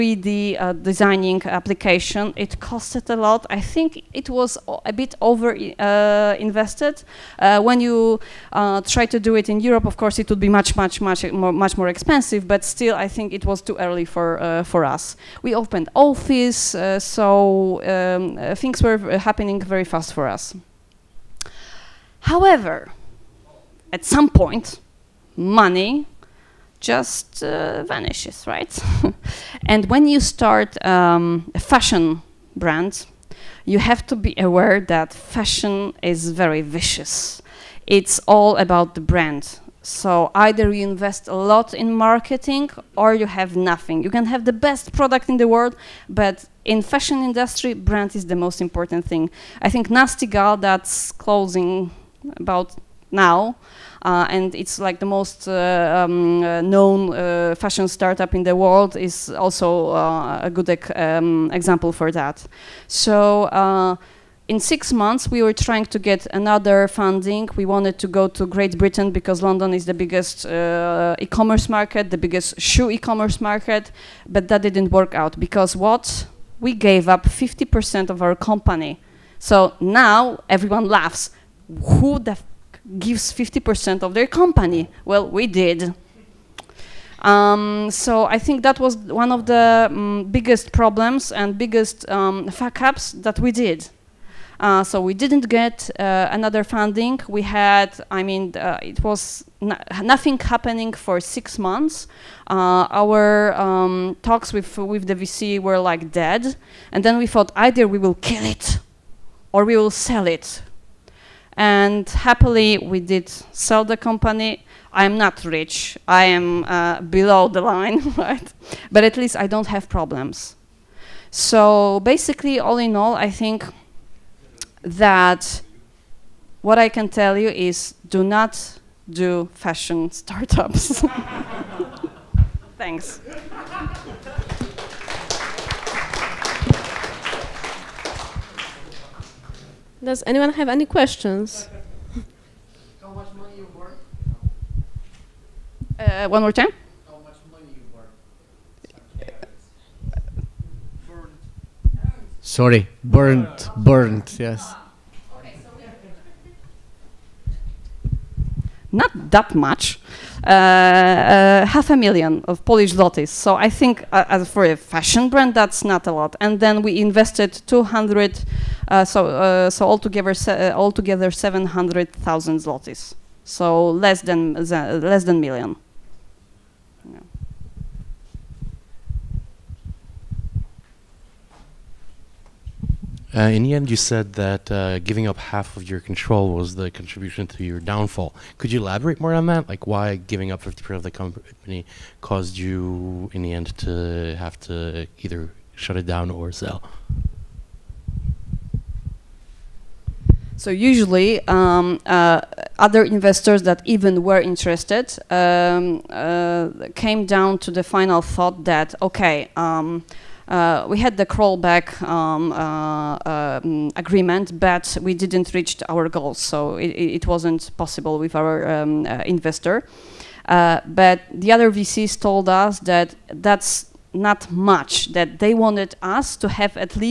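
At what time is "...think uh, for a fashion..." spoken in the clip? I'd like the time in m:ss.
2:43.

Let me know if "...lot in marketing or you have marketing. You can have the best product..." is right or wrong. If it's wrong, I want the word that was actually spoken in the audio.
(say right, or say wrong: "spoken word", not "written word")
wrong: "nothing", not "marketing".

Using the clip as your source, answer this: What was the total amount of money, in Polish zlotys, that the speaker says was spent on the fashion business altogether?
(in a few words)
700,000 zlotys.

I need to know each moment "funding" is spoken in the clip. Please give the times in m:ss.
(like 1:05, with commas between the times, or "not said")
1:06, 1:36.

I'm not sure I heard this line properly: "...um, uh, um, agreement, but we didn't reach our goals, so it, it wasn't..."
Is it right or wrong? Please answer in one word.
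right.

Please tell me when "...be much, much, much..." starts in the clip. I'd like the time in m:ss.
0:10.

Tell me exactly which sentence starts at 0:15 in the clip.
We opened office, so um, things were happening very fast for us.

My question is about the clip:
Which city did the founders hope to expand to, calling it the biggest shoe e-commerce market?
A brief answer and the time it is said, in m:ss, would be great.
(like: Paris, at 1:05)
London, at 1:09.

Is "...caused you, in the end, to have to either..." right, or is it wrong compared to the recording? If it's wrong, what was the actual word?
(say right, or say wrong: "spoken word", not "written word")
right.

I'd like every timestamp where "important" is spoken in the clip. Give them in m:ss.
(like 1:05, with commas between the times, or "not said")
0:48.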